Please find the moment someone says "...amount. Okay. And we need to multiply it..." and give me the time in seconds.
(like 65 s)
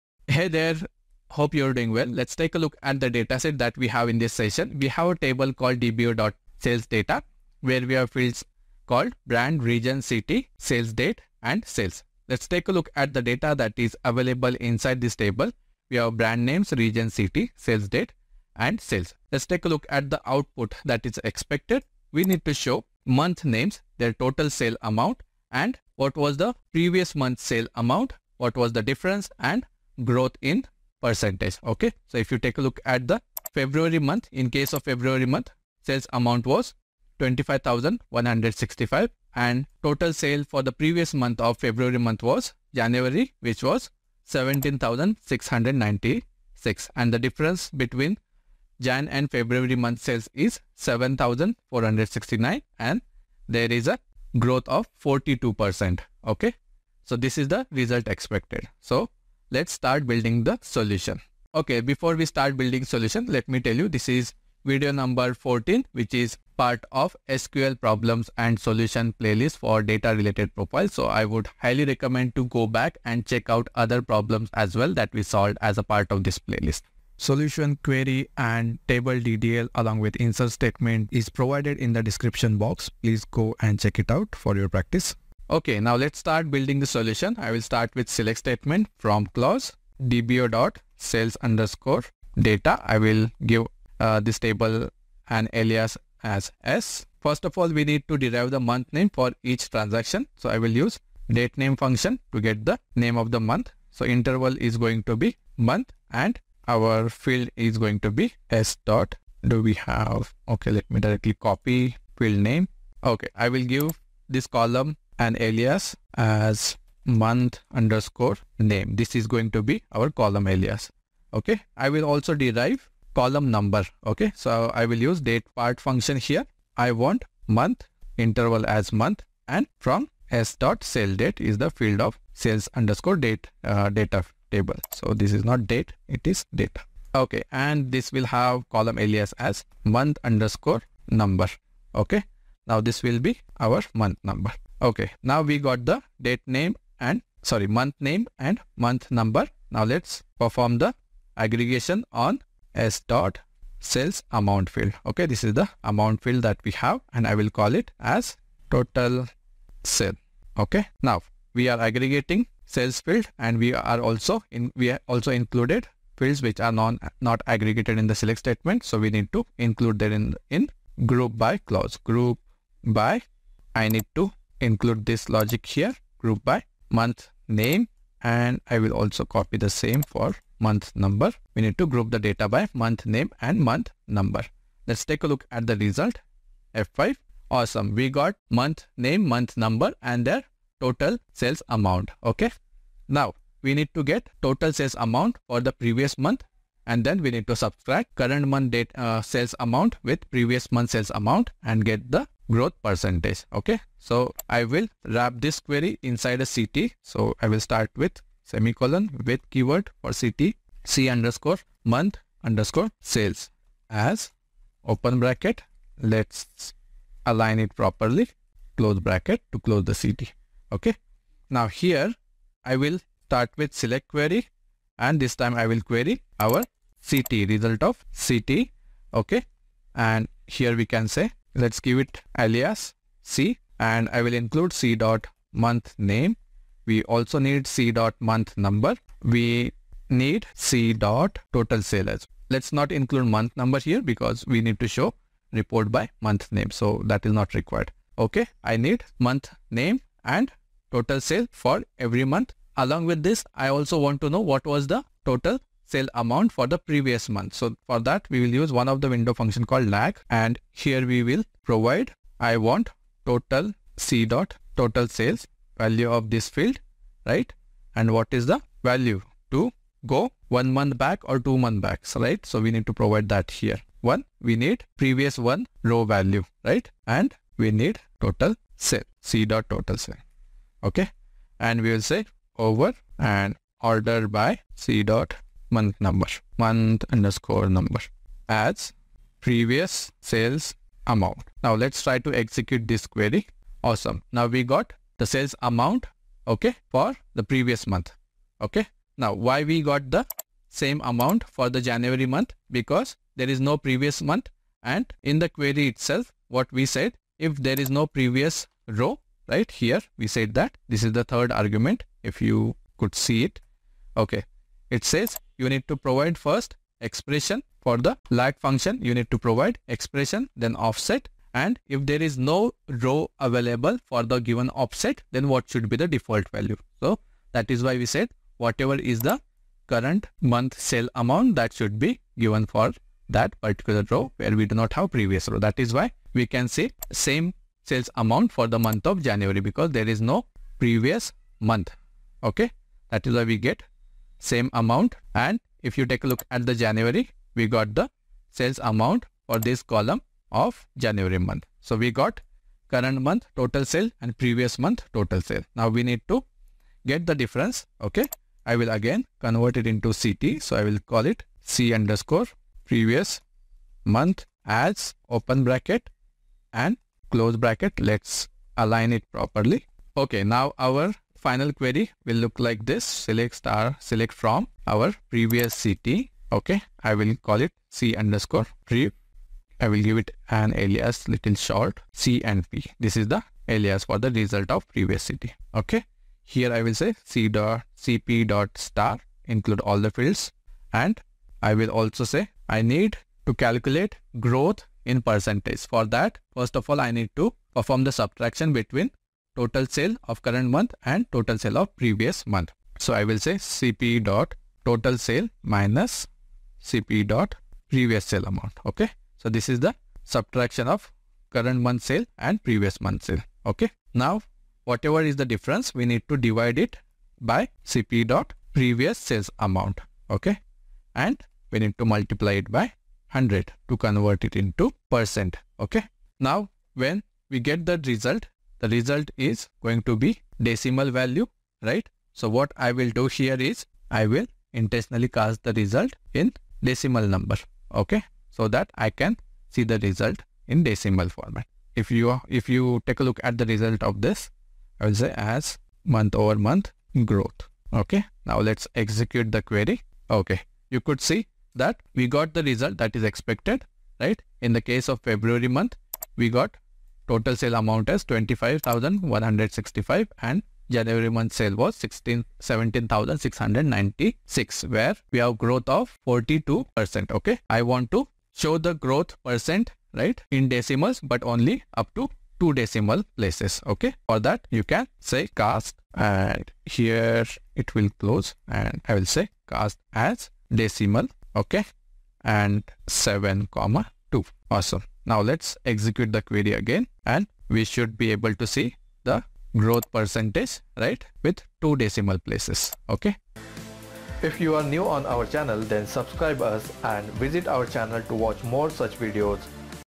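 419 s.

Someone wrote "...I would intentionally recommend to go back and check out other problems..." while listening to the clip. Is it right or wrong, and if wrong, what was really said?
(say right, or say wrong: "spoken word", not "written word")
wrong: "highly", not "intentionally".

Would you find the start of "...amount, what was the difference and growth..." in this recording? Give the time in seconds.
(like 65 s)
27 s.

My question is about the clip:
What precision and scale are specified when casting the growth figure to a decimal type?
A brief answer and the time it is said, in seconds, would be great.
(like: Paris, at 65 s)
7,2, at 483 s.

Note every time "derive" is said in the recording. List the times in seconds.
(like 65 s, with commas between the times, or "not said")
98 s, 122 s.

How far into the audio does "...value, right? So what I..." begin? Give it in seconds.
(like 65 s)
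431 s.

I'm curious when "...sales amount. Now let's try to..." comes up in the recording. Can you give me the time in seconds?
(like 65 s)
290 s.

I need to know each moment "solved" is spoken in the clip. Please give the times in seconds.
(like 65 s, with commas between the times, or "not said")
75 s.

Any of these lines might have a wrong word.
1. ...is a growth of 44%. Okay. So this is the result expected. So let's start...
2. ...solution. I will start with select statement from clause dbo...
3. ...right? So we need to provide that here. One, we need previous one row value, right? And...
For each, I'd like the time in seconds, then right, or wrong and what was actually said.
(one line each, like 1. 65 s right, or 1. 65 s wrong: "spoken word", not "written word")
1. 53 s wrong: "42", not "44"
2. 86 s right
3. 272 s right.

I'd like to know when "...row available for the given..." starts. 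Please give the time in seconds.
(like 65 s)
322 s.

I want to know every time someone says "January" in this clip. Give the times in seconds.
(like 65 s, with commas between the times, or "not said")
42 s, 301 s, 339 s, 346 s, 350 s, 460 s.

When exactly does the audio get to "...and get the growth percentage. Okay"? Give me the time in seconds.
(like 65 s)
201 s.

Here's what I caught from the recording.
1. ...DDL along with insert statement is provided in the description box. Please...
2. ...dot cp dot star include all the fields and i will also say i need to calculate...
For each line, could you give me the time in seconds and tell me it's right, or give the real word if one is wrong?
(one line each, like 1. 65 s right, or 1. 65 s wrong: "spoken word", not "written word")
1. 79 s right
2. 387 s right.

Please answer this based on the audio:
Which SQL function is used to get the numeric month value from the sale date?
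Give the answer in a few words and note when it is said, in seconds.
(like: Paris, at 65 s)
date part, at 125 s.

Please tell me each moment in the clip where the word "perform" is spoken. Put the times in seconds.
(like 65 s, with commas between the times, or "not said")
150 s, 397 s.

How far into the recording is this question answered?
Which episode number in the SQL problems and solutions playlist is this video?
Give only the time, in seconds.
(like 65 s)
65 s.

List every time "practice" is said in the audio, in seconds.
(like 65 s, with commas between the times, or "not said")
84 s.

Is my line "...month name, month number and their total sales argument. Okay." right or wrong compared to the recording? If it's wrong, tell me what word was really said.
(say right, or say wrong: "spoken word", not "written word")
wrong: "amount", not "argument".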